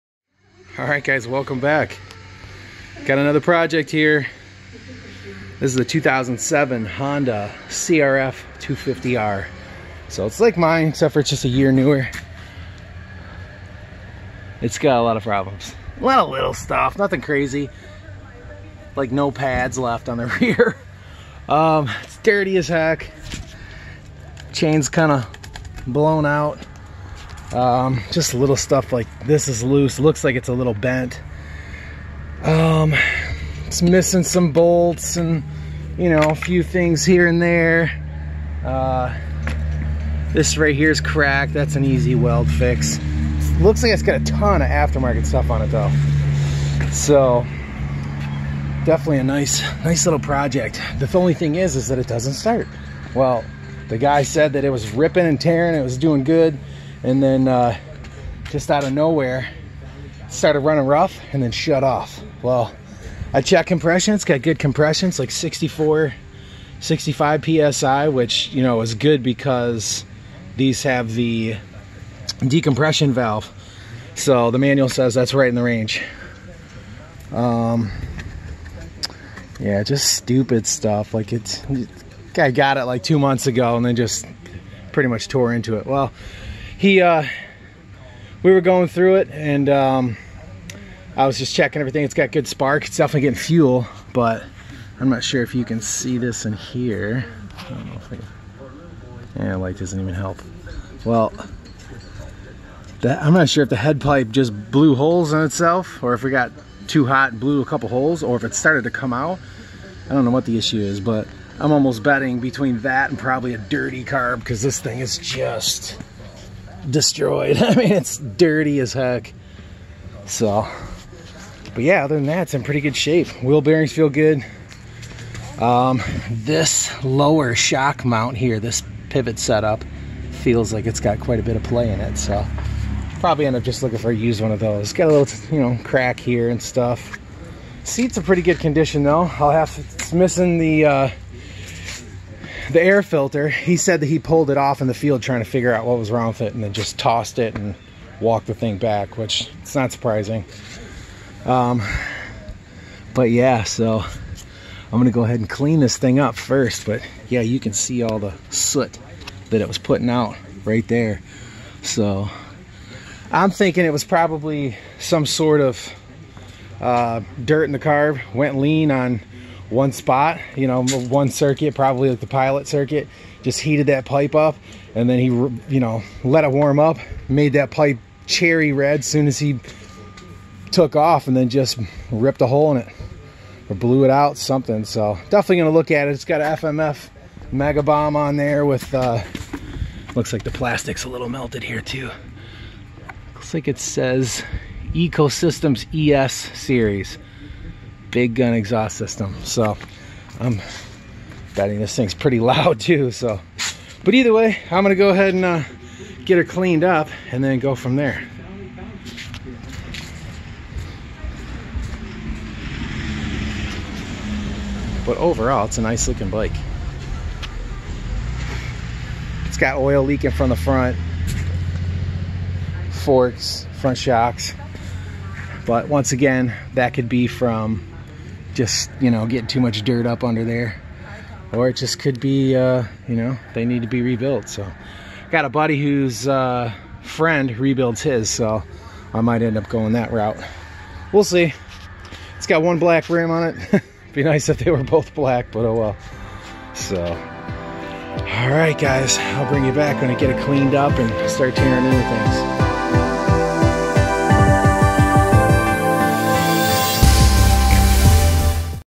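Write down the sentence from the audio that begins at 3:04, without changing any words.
So definitely gonna look at it.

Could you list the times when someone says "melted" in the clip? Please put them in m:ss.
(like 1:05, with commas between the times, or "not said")
3:11.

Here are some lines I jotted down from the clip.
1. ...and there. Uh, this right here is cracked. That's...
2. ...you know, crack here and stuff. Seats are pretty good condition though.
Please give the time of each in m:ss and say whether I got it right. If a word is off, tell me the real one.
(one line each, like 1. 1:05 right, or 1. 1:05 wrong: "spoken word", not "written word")
1. 0:37 right
2. 2:15 right.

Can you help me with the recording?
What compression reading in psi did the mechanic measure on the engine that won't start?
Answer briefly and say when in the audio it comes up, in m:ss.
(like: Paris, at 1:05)
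64 65 psi, at 1:05.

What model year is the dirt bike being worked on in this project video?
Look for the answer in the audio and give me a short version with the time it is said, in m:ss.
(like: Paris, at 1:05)
2007, at 0:05.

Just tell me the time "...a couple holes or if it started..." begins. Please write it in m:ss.
1:47.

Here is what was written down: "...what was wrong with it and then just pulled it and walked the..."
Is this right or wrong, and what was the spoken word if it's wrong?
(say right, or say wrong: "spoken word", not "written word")
wrong: "tossed", not "pulled".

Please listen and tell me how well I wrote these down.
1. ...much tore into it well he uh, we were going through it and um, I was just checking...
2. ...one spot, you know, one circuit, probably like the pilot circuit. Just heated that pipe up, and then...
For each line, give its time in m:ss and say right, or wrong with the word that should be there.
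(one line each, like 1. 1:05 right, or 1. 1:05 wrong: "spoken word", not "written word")
1. 1:25 right
2. 2:49 right.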